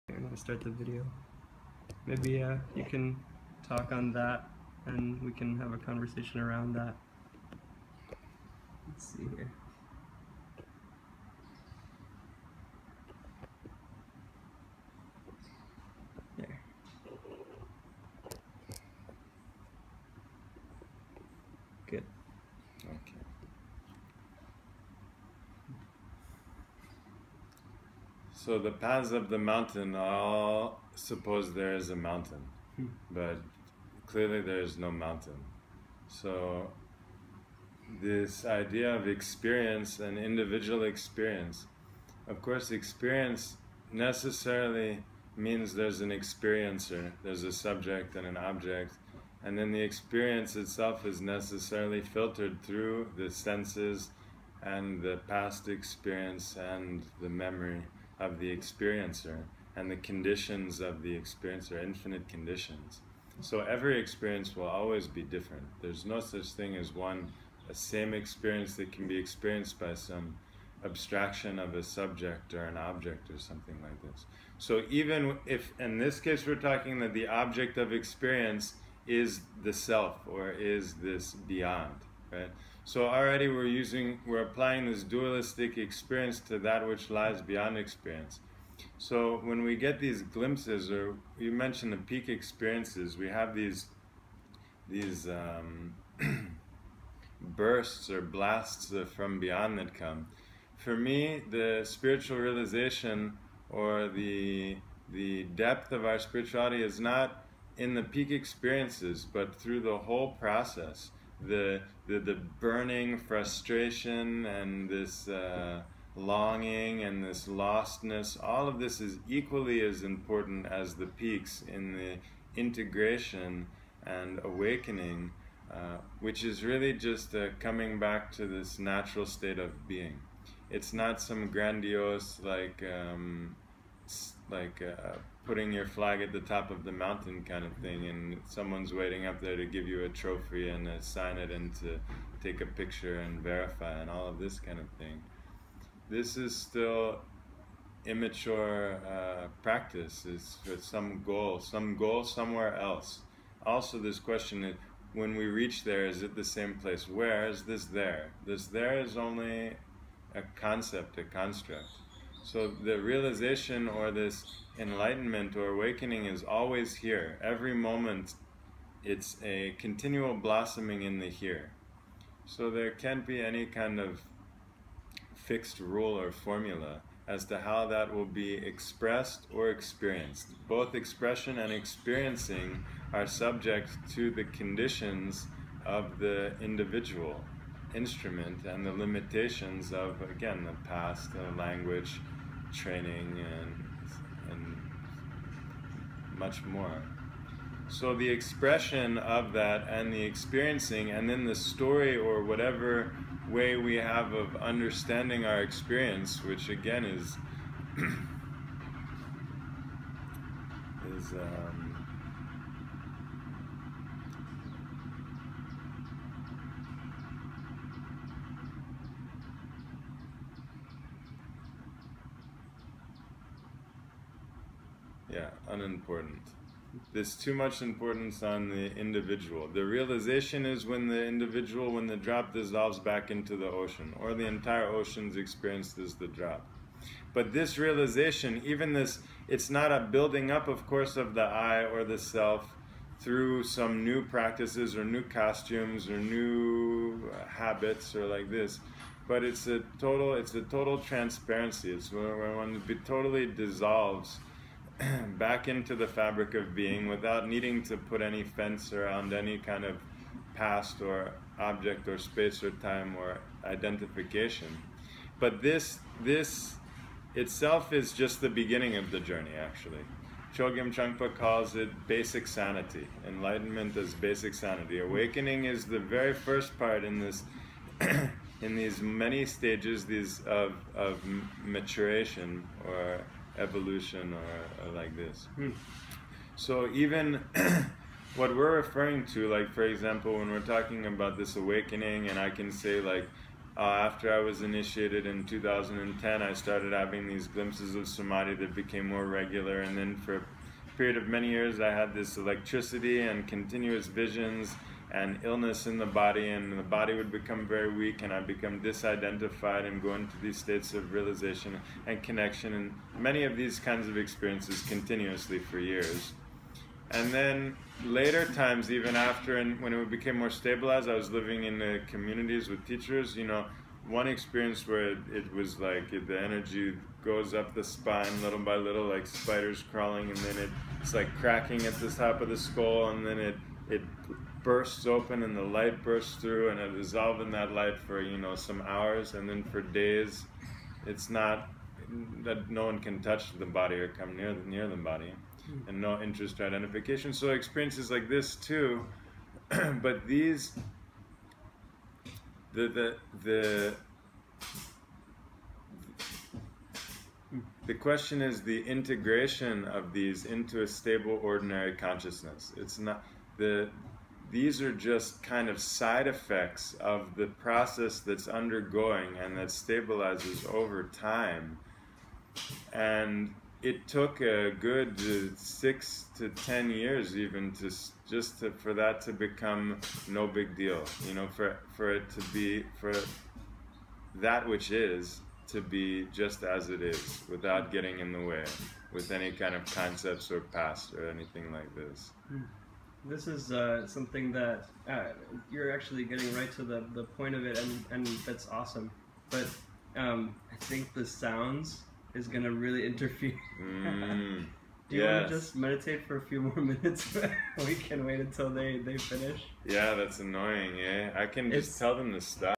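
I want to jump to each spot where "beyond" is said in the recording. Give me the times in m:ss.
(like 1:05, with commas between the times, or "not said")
1:21, 1:27, 1:39.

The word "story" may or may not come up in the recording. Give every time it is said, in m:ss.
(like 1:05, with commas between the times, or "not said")
3:21.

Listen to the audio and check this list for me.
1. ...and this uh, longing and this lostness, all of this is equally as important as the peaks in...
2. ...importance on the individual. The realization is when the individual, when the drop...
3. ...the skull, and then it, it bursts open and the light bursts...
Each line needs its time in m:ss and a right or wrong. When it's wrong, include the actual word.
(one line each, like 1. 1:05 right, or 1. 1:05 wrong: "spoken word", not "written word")
1. 1:54 right
2. 3:47 right
3. 5:32 right.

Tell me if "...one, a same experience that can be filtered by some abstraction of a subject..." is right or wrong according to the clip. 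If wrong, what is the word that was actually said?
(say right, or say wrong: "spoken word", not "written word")
wrong: "experienced", not "filtered".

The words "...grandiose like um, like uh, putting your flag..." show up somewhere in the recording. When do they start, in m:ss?
2:11.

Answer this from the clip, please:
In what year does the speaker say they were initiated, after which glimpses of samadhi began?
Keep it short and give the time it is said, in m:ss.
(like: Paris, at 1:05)
2010, at 4:55.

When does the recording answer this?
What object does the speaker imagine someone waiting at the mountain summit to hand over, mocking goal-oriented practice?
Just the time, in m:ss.
2:20.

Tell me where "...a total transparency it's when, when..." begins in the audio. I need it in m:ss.
4:10.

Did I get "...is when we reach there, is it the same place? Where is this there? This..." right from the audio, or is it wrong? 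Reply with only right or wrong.
right.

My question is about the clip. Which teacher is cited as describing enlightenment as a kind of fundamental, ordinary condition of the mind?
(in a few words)
Chogyam Trungpa.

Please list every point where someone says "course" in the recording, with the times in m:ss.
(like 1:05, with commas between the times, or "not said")
0:42, 4:00.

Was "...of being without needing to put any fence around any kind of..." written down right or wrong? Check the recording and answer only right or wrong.
right.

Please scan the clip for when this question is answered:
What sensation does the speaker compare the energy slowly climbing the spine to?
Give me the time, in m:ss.
5:29.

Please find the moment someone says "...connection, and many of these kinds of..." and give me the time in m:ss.
5:12.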